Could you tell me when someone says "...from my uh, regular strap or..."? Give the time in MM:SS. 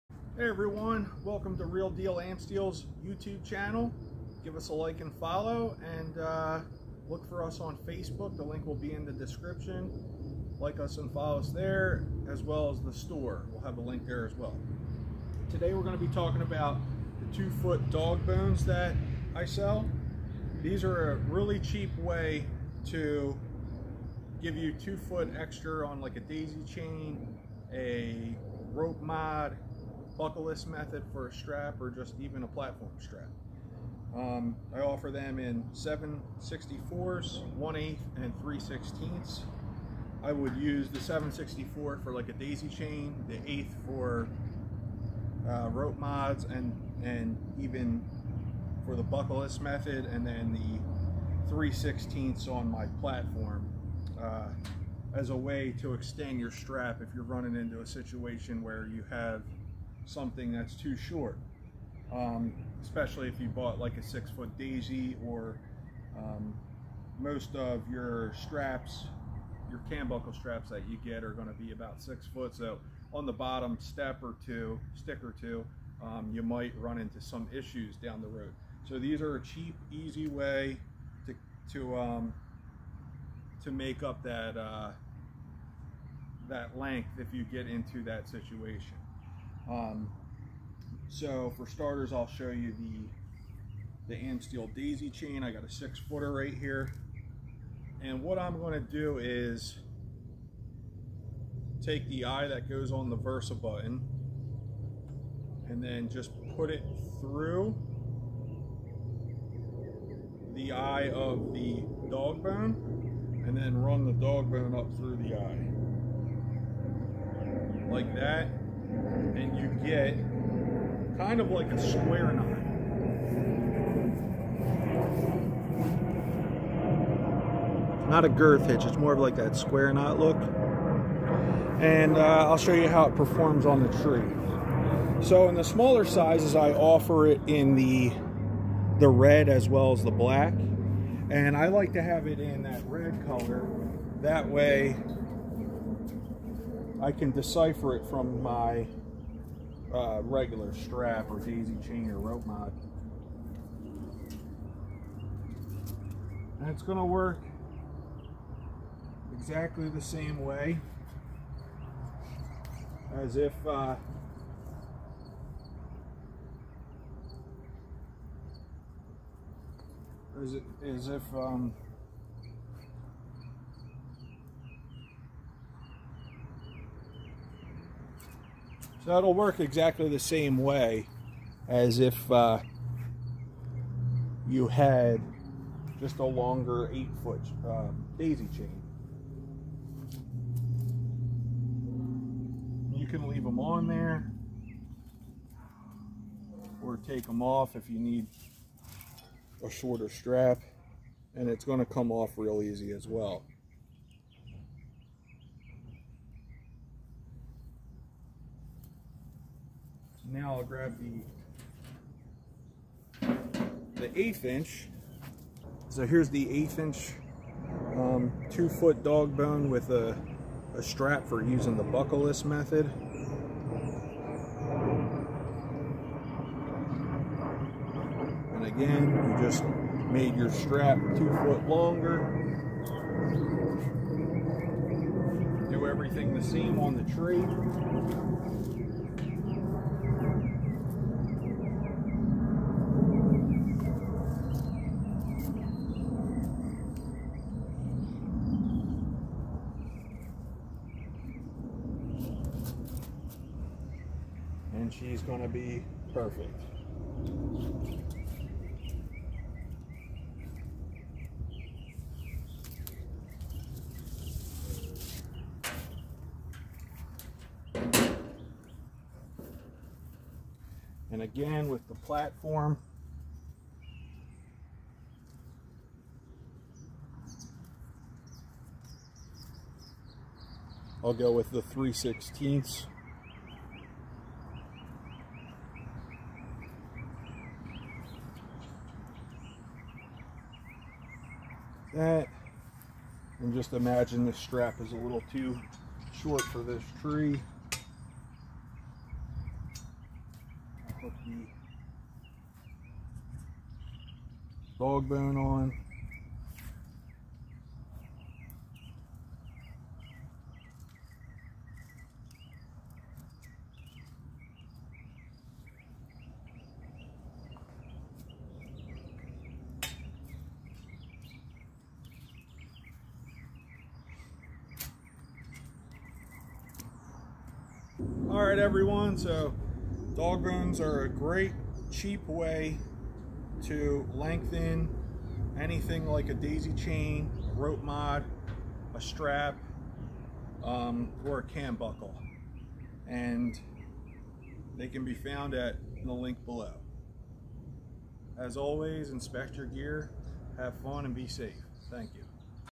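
02:28.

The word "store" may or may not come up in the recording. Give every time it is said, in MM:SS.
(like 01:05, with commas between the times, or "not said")
00:12.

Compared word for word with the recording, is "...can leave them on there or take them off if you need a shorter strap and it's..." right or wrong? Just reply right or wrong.
right.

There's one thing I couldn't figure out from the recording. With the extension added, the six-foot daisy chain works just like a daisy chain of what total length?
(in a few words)
eight foot.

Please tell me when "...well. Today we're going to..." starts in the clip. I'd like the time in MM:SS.
00:14.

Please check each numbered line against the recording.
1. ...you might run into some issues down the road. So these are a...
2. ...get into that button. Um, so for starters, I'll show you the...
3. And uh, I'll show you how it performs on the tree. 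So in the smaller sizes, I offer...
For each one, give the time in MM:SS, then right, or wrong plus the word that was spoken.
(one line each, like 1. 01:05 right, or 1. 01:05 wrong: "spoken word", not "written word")
1. 01:16 right
2. 01:27 wrong: "situation", not "button"
3. 02:11 right.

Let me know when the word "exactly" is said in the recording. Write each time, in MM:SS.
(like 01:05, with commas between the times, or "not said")
02:39, 02:59.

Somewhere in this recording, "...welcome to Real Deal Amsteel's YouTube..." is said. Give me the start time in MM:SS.
00:01.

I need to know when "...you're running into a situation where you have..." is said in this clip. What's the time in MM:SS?
00:57.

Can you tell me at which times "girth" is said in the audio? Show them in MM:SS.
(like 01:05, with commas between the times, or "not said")
02:08.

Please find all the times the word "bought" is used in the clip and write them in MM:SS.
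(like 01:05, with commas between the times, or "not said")
01:03.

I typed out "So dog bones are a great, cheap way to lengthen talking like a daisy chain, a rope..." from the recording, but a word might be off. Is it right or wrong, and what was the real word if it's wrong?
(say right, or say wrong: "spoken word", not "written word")
wrong: "anything", not "talking".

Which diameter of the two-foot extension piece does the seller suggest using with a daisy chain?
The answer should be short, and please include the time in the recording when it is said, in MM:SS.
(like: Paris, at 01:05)
7/64, at 00:40.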